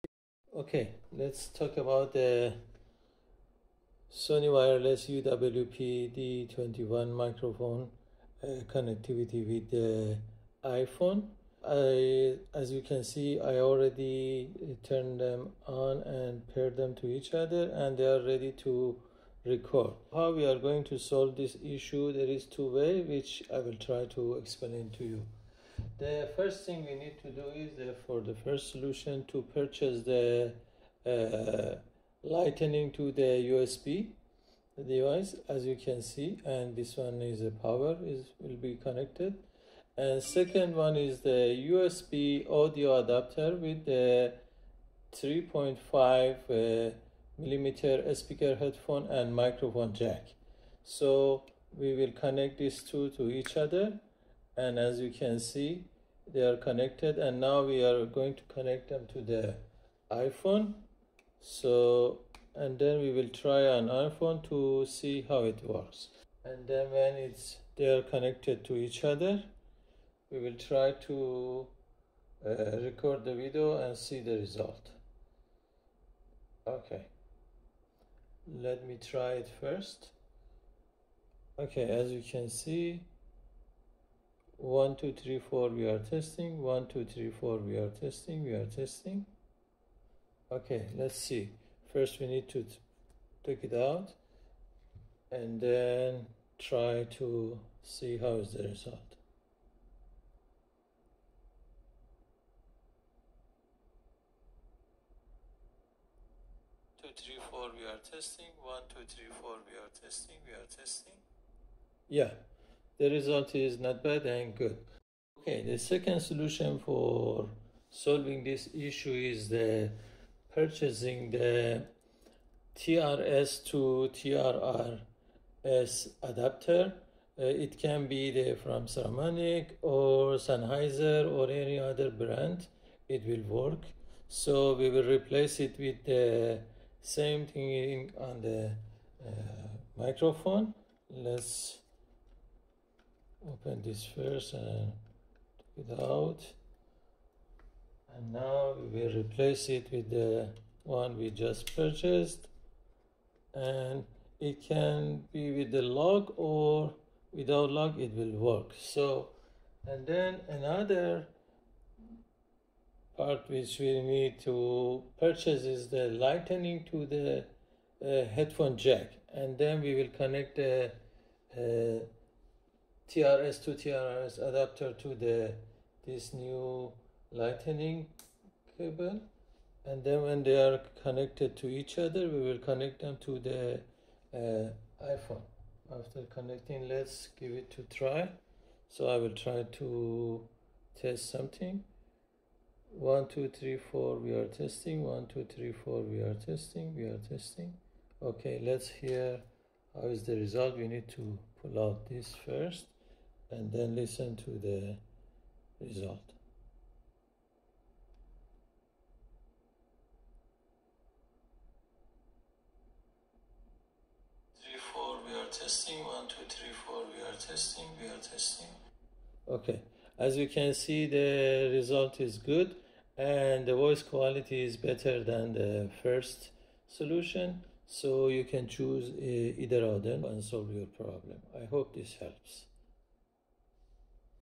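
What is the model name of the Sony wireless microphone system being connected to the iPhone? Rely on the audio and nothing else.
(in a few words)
UWP-D21.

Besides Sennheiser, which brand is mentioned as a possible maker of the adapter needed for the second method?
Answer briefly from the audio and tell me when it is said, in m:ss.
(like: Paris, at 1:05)
Saramonic, at 2:08.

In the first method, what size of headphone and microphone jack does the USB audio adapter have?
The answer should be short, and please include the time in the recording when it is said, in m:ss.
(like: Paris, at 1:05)
3.5 millimeter, at 0:45.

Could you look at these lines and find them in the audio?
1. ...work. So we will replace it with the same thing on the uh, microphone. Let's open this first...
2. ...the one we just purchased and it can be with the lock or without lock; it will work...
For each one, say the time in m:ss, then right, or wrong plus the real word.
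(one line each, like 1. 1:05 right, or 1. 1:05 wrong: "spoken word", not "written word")
1. 2:13 right
2. 2:30 right.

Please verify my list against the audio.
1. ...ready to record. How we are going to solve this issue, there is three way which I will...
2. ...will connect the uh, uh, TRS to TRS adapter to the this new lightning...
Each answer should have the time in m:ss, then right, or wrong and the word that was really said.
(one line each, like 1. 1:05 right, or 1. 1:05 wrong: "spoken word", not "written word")
1. 0:18 wrong: "two", not "three"
2. 2:49 right.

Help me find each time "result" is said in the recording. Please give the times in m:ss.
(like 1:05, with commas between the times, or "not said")
1:14, 1:38, 1:53, 3:20, 3:25, 3:41.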